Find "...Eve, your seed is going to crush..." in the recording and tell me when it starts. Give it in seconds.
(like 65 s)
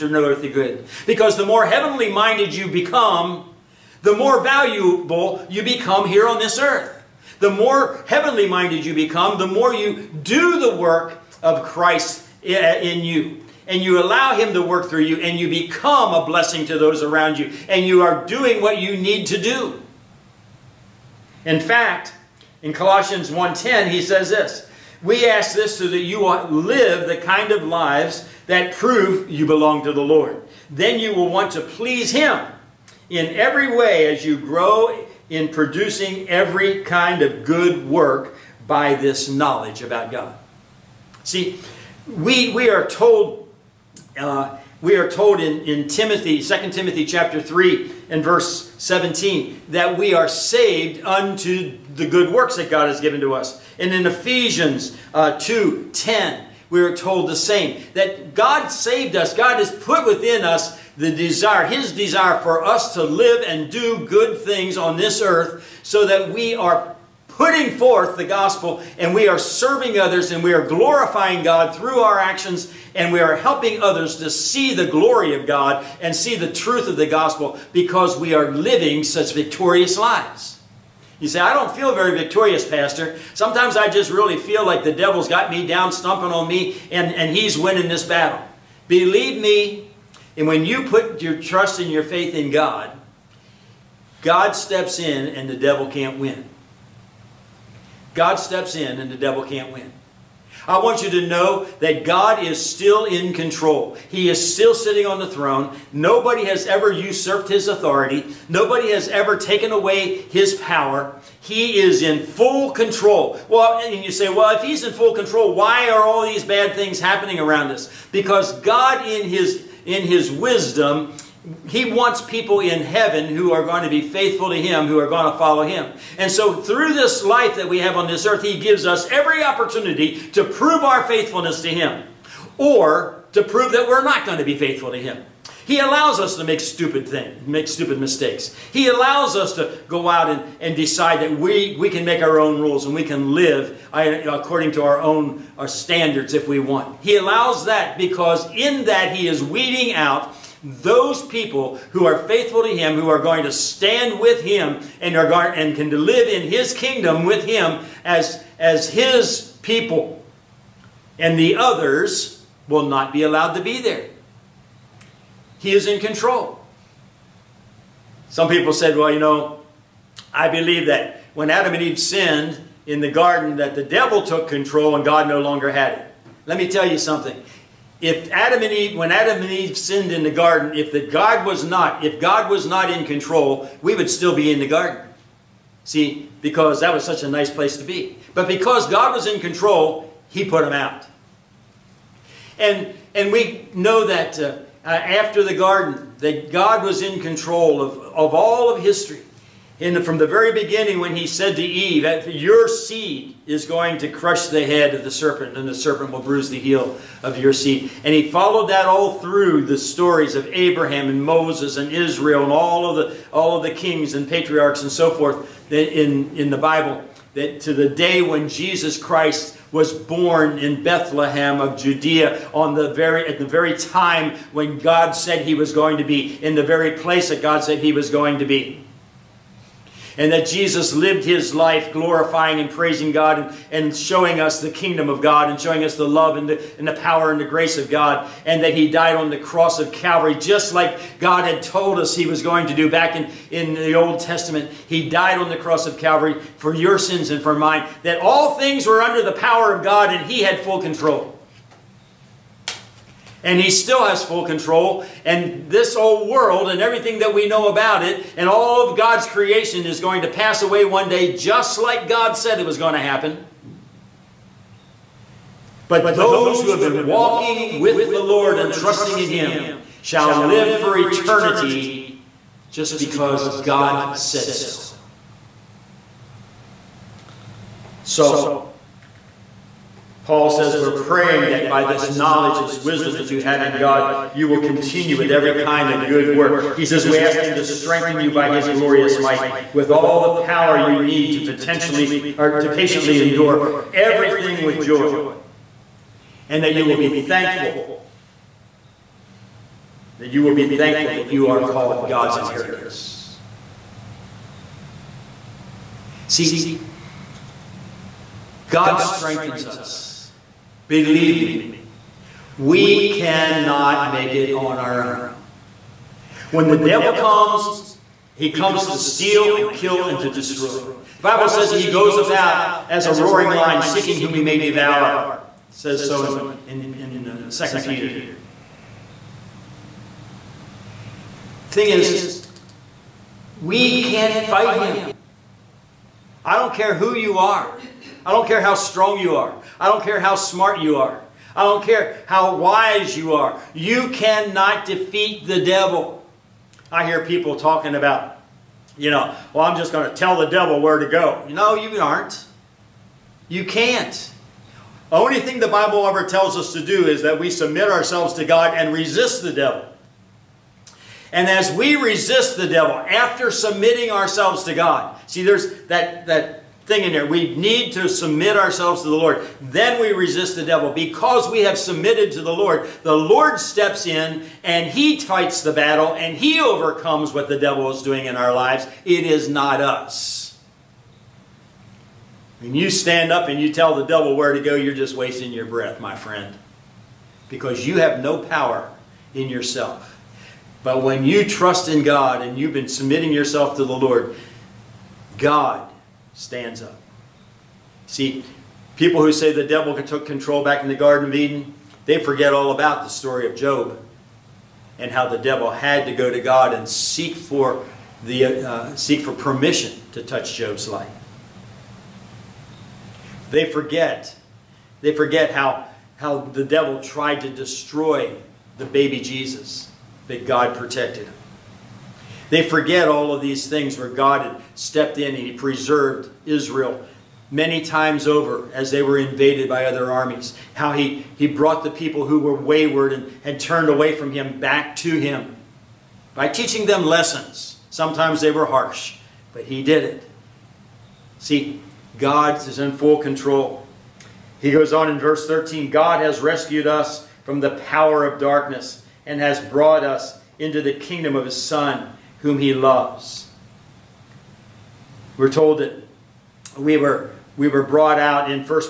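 201 s.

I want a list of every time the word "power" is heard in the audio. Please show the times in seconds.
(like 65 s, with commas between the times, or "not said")
110 s, 236 s, 249 s, 290 s, 388 s, 447 s.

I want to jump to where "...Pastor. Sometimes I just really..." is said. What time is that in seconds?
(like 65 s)
82 s.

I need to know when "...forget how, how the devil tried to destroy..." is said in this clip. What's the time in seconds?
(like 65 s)
415 s.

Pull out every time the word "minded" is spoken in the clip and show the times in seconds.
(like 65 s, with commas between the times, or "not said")
2 s, 8 s.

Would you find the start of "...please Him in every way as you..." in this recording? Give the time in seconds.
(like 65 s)
31 s.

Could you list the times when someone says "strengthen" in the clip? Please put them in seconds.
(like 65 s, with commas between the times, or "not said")
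287 s, 308 s.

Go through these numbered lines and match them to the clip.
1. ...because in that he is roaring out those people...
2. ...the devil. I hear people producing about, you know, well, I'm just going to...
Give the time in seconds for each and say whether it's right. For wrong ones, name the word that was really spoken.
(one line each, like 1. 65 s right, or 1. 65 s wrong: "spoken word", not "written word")
1. 147 s wrong: "weeding", not "roaring"
2. 345 s wrong: "talking", not "producing".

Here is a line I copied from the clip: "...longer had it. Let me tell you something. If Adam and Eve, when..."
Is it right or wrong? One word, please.
right.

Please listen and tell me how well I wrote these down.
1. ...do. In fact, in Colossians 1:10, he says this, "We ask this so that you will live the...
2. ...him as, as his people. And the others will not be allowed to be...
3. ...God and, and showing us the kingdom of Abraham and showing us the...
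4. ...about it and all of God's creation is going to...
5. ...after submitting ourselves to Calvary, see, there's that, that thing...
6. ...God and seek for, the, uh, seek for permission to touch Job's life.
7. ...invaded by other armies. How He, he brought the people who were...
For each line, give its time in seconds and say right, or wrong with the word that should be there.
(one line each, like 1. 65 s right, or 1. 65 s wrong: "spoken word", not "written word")
1. 19 s right
2. 157 s right
3. 233 s wrong: "God", not "Abraham"
4. 257 s right
5. 362 s wrong: "God", not "Calvary"
6. 406 s right
7. 429 s right.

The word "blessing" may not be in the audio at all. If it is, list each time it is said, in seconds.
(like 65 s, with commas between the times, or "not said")
16 s.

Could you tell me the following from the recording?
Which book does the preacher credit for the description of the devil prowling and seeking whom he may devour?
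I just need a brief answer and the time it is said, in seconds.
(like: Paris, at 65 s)
2 Peter, at 327 s.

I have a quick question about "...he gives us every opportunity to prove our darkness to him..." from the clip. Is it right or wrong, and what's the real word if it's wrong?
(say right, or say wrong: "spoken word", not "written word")
wrong: "faithfulness", not "darkness".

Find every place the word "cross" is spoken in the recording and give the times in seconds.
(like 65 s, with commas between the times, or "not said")
239 s, 245 s.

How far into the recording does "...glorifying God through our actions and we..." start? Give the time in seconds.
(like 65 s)
70 s.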